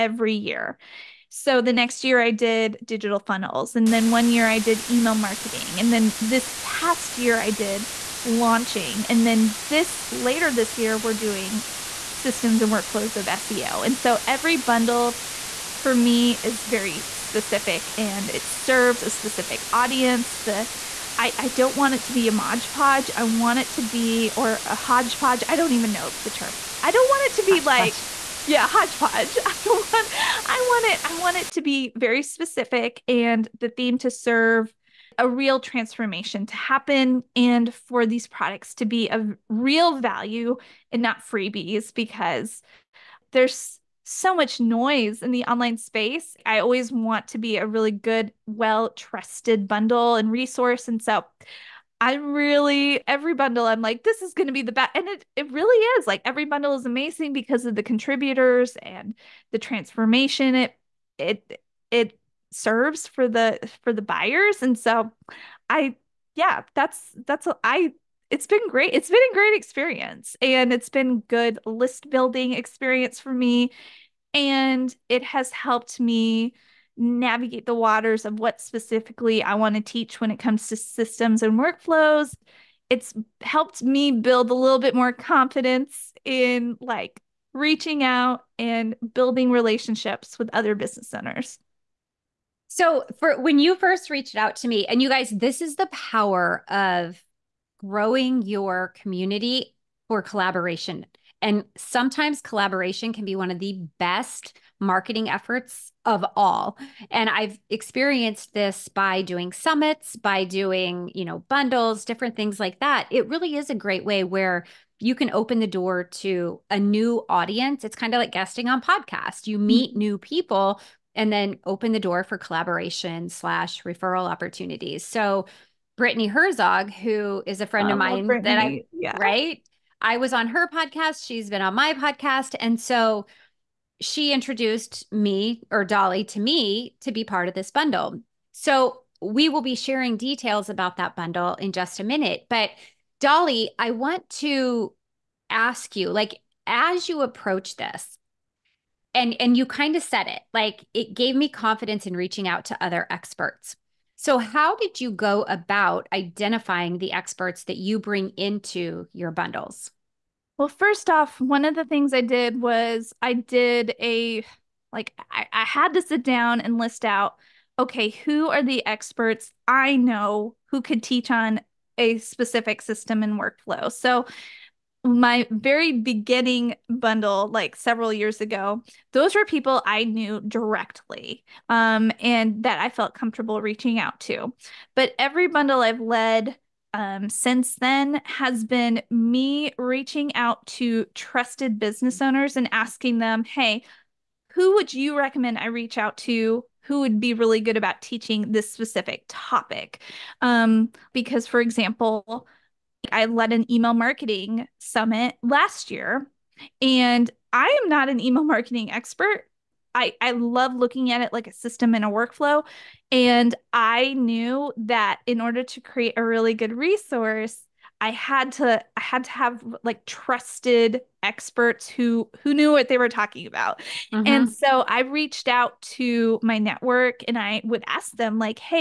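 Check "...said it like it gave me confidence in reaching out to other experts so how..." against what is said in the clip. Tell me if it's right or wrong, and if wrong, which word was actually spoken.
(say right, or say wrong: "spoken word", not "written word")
right.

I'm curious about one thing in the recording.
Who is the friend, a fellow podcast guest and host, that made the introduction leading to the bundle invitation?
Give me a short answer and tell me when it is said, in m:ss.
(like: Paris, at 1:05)
Brittany Herzog, at 2:05.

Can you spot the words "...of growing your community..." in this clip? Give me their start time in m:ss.
1:36.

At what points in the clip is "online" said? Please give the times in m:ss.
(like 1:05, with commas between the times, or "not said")
0:45.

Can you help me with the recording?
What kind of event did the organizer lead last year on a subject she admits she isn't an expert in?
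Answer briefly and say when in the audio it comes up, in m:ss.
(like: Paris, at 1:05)
email marketing summit, at 3:23.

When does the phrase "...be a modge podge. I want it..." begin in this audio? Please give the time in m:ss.
0:22.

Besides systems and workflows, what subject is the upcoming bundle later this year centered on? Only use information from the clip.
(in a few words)
SEO.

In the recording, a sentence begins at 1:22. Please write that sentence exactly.
It's helped me build a little bit more confidence in like reaching out and building relationships with other business owners.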